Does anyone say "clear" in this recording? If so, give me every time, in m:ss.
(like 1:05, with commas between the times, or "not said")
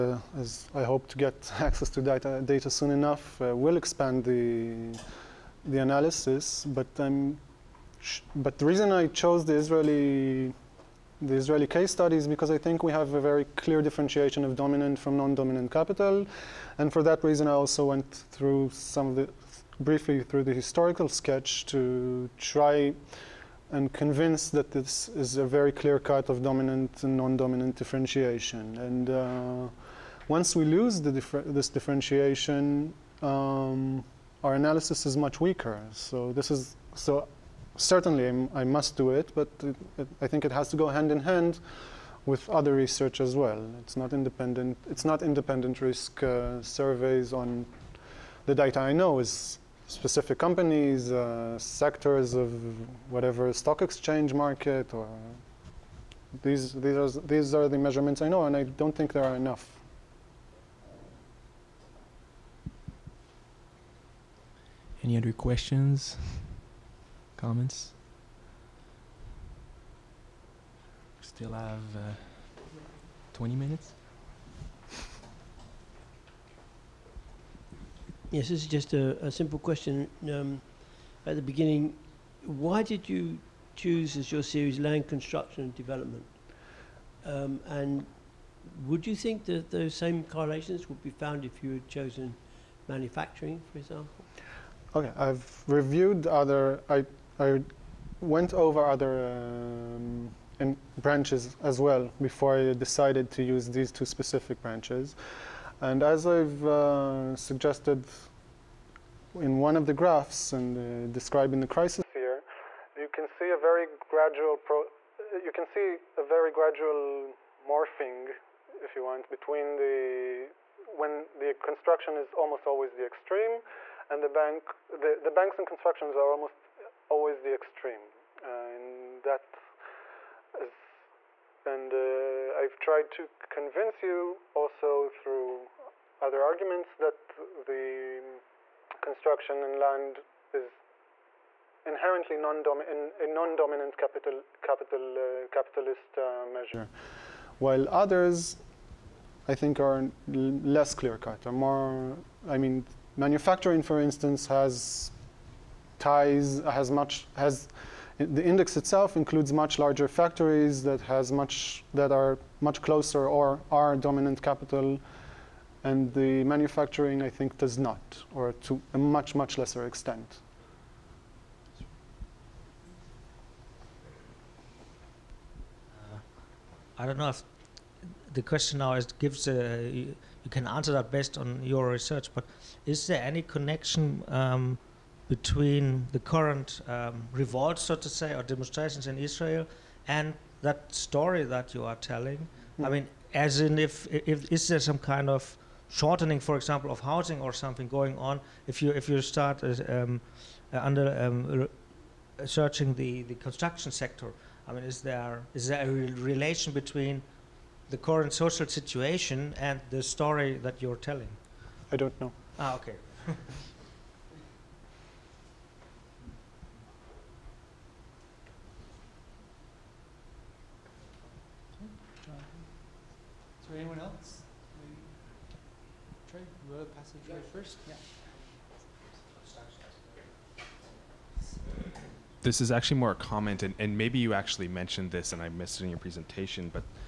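0:13, 0:25, 2:30.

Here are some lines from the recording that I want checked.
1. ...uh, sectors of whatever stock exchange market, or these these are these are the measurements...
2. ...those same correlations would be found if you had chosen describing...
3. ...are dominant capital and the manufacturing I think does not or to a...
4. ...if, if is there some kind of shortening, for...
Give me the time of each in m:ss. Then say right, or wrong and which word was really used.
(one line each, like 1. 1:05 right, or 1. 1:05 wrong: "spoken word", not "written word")
1. 0:51 right
2. 1:29 wrong: "manufacturing", not "describing"
3. 2:43 right
4. 3:13 right.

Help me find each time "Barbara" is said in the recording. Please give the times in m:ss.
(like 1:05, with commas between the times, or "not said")
not said.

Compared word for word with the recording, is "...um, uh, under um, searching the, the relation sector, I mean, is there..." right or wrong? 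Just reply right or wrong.
wrong.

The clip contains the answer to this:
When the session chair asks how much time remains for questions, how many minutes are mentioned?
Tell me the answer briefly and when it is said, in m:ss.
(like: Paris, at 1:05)
20, at 1:13.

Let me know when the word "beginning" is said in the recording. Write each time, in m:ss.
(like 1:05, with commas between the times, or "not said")
1:21.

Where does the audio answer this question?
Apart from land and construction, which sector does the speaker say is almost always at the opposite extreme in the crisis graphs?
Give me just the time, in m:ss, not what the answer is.
2:05.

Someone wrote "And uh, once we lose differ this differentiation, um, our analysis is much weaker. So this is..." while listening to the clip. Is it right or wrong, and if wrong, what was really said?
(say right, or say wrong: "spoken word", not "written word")
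right.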